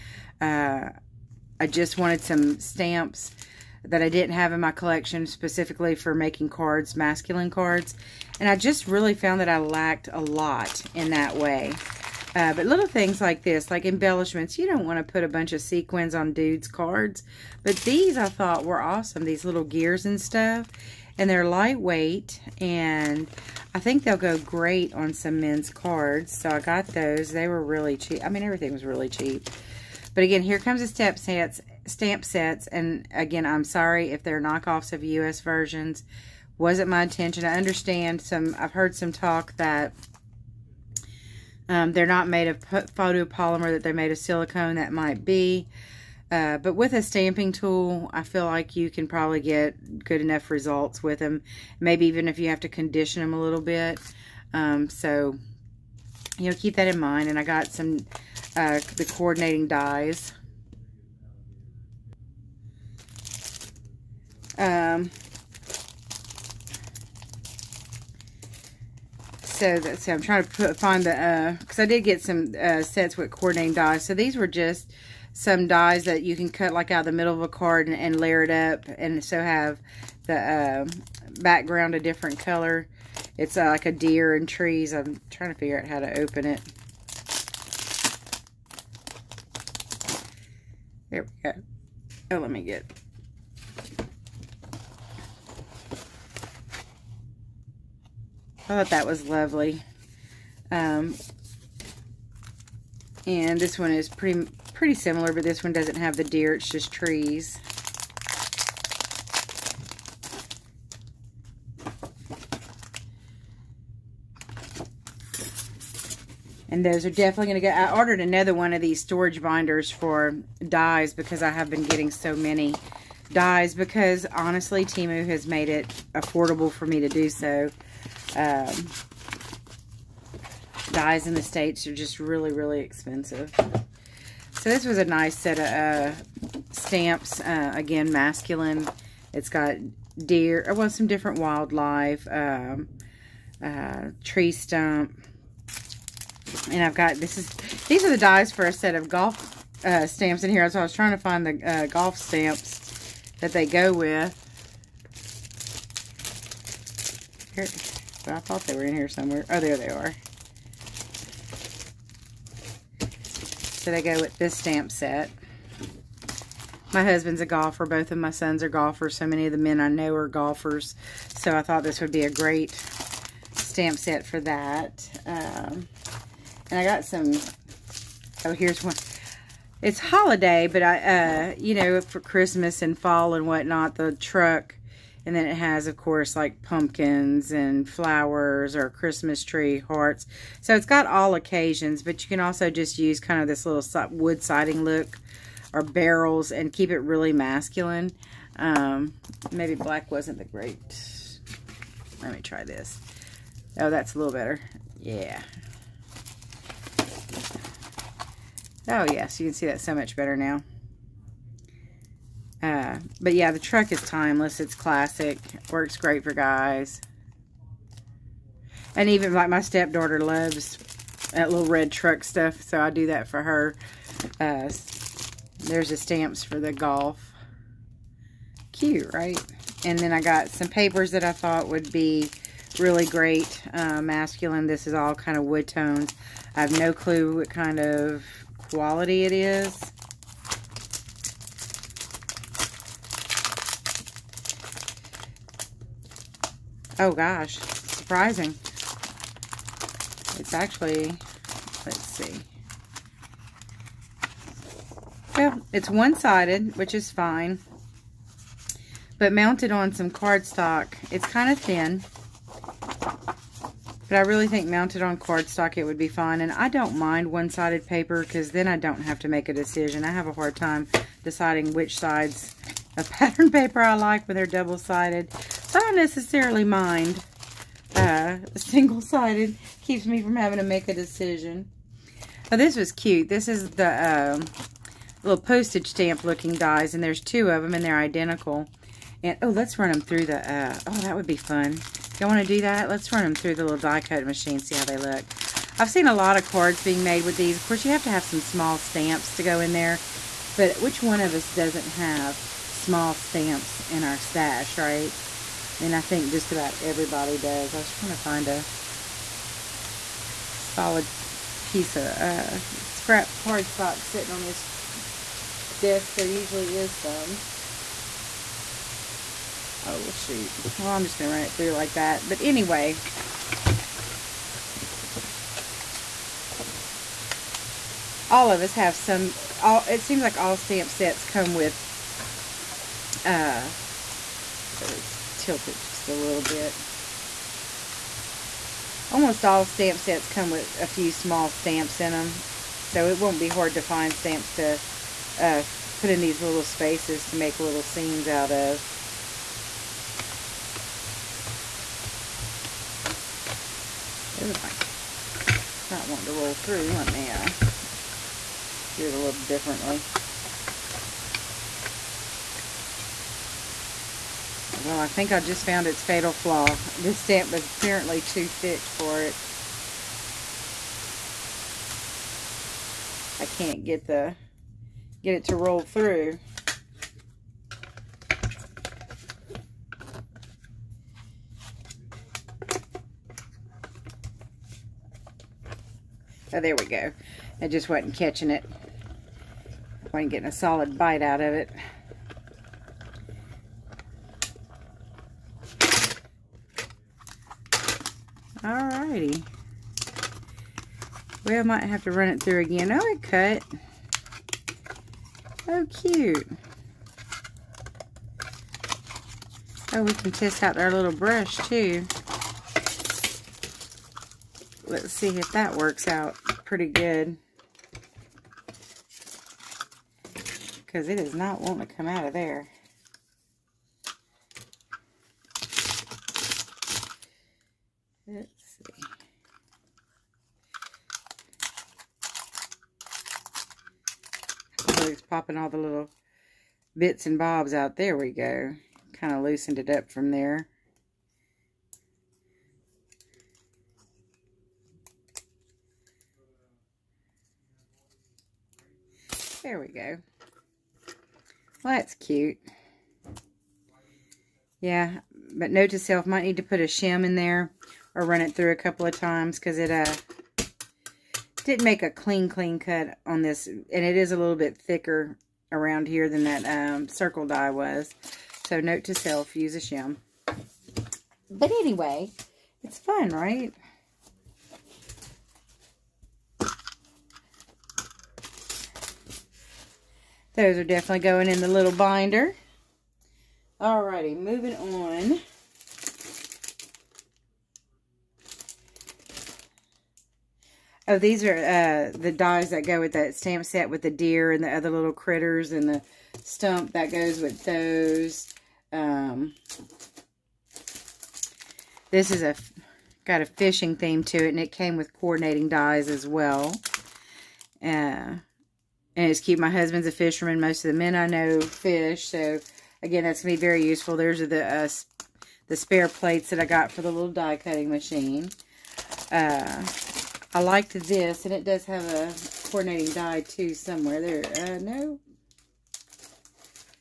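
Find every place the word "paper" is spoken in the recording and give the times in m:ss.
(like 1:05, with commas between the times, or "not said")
3:50, 4:27, 4:33.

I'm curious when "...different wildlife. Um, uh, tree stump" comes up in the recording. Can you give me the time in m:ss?
2:21.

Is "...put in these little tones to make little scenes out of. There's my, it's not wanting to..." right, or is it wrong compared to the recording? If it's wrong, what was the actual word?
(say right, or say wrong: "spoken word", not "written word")
wrong: "spaces", not "tones".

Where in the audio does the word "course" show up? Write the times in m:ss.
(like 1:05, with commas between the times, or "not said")
3:05, 4:57.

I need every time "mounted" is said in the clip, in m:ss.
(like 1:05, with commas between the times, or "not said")
4:19, 4:24.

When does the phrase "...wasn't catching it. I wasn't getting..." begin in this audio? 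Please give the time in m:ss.
6:27.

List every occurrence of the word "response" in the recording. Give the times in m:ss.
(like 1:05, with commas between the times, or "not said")
not said.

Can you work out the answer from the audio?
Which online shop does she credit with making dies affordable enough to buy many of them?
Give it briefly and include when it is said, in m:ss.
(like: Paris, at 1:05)
Temu, at 2:04.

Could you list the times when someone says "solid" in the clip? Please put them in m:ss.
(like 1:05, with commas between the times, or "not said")
5:10, 6:30.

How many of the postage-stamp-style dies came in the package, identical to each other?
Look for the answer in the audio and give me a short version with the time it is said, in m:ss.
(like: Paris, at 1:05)
2, at 4:47.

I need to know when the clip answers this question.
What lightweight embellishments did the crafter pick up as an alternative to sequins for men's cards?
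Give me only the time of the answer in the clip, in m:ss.
0:19.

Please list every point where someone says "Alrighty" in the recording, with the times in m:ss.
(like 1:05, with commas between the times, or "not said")
6:39, 8:03.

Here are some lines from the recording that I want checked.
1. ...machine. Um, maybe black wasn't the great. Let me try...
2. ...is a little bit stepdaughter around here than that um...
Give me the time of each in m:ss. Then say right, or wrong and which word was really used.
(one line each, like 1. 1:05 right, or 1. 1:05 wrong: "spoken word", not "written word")
1. 3:17 wrong: "masculine", not "machine"
2. 7:44 wrong: "thicker", not "stepdaughter".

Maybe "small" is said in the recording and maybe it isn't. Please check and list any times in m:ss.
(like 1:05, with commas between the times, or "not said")
4:58, 5:02, 5:41.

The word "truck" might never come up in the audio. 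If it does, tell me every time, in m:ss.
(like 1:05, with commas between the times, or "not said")
3:04, 3:33, 3:41.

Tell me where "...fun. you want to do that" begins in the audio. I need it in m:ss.
4:51.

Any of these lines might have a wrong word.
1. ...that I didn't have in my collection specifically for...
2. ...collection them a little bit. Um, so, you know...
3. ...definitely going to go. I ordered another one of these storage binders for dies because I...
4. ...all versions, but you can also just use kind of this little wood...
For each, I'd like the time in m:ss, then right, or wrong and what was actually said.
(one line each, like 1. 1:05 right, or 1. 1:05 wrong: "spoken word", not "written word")
1. 0:03 right
2. 0:52 wrong: "condition", not "collection"
3. 1:57 right
4. 3:11 wrong: "occasions", not "versions".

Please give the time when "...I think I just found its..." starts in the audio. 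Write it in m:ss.
6:05.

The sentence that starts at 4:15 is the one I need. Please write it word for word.
Yeah, it's one-sided, which is fine.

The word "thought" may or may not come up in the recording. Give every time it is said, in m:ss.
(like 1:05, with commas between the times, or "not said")
0:18, 1:38, 2:38, 2:51, 3:51.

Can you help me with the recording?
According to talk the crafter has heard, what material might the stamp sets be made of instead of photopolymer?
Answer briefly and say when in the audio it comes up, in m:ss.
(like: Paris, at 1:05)
silicone, at 0:44.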